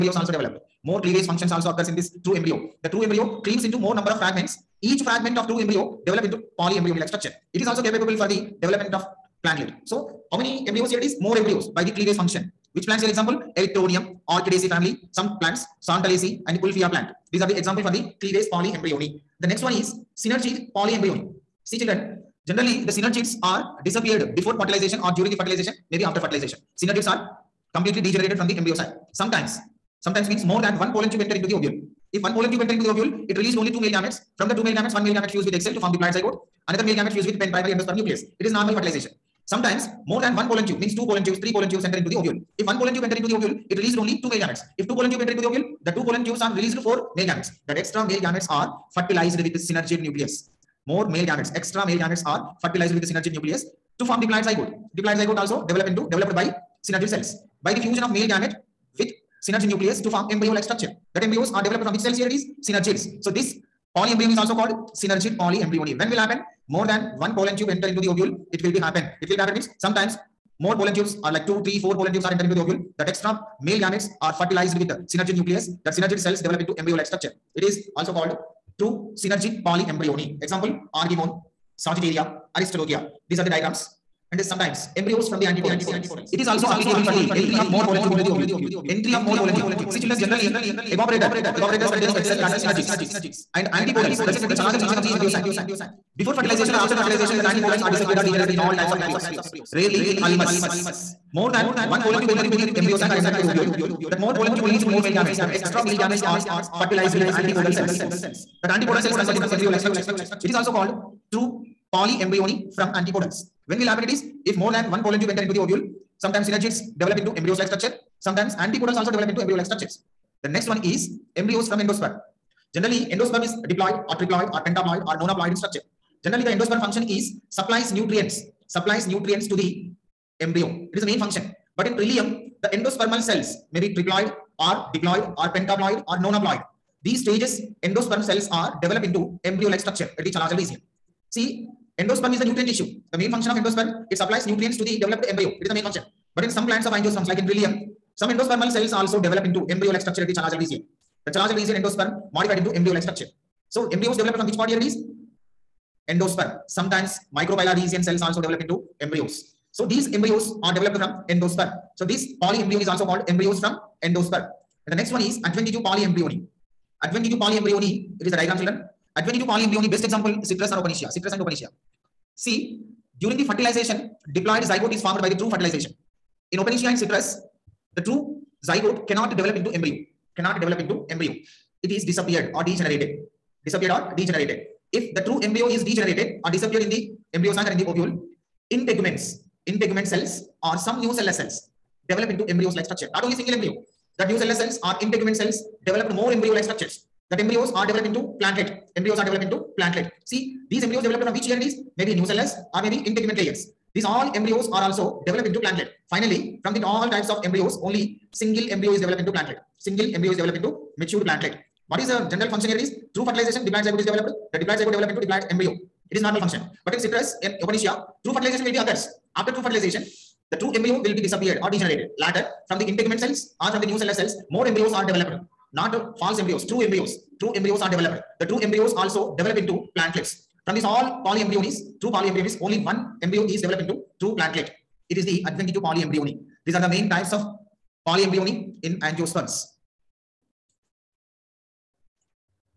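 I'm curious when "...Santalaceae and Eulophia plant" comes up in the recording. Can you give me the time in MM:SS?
00:15.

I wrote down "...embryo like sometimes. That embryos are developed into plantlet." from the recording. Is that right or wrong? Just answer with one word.
wrong.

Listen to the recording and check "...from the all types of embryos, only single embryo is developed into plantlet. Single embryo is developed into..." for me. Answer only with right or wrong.
right.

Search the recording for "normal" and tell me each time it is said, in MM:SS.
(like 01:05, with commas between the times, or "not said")
00:38, 03:36.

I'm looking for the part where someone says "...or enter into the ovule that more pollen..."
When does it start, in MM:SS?
01:43.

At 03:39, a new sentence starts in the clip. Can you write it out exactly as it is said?
After true fertilization, the true embryo will be disappeared or degenerated.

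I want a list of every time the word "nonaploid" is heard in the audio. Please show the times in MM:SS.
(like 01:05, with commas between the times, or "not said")
02:05, 02:16.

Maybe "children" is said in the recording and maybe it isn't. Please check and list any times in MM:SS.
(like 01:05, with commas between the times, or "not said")
00:21, 01:30, 02:48.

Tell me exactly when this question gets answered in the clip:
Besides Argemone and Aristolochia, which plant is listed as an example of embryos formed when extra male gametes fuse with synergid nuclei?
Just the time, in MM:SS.
01:21.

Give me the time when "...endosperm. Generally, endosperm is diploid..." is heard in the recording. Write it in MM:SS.
02:01.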